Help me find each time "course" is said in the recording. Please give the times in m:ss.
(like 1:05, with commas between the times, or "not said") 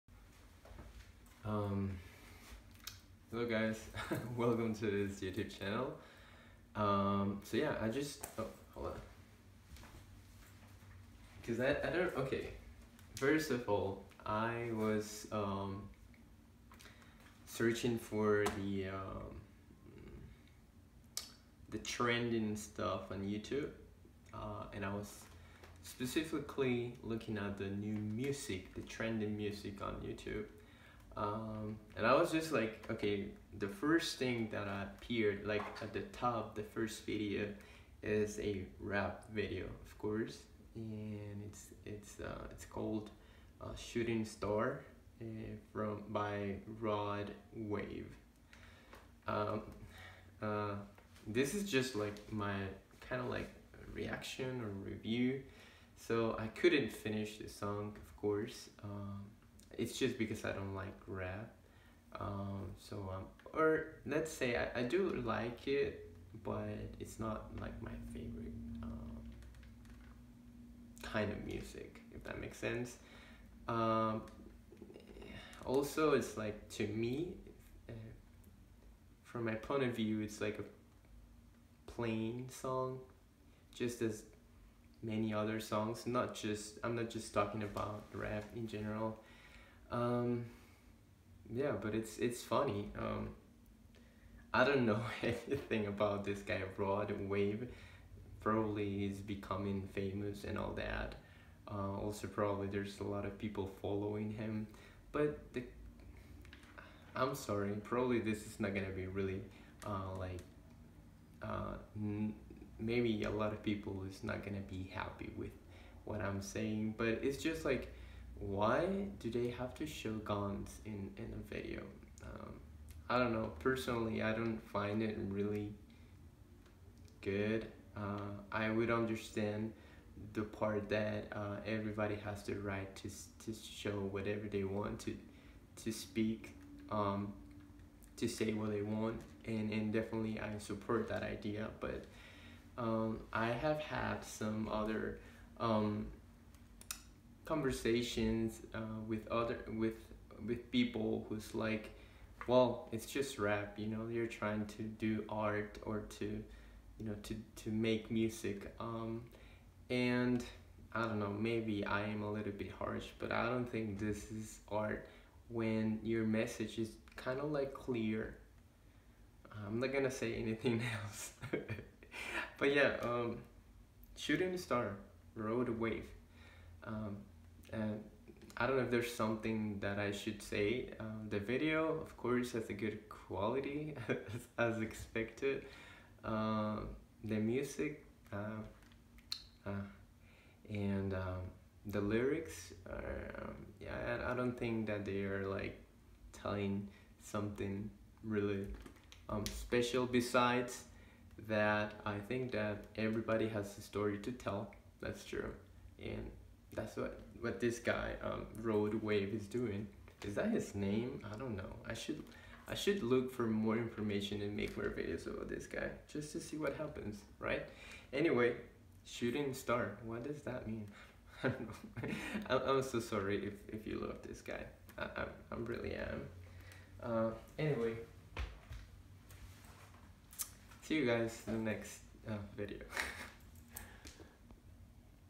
0:39, 0:58, 3:02.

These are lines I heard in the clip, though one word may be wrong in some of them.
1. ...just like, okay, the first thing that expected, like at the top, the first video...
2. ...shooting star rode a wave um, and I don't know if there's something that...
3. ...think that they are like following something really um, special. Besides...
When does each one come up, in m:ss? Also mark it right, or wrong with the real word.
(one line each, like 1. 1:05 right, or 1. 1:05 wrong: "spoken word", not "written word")
1. 0:32 wrong: "appeared", not "expected"
2. 2:54 right
3. 3:14 wrong: "telling", not "following".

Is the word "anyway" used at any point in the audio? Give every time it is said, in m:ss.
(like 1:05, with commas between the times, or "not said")
3:38, 3:47.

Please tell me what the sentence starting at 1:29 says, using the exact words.
Um, yeah, but it's it's funny.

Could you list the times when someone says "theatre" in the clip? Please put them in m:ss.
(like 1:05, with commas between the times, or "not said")
not said.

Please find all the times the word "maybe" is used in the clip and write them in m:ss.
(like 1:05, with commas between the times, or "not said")
1:52, 2:41.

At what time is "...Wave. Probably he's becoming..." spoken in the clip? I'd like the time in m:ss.
1:37.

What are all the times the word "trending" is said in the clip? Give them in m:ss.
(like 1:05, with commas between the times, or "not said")
0:21, 0:28.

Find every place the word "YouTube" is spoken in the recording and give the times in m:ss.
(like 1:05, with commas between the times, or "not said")
0:05, 0:23, 0:30.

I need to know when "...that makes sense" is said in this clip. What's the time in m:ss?
1:12.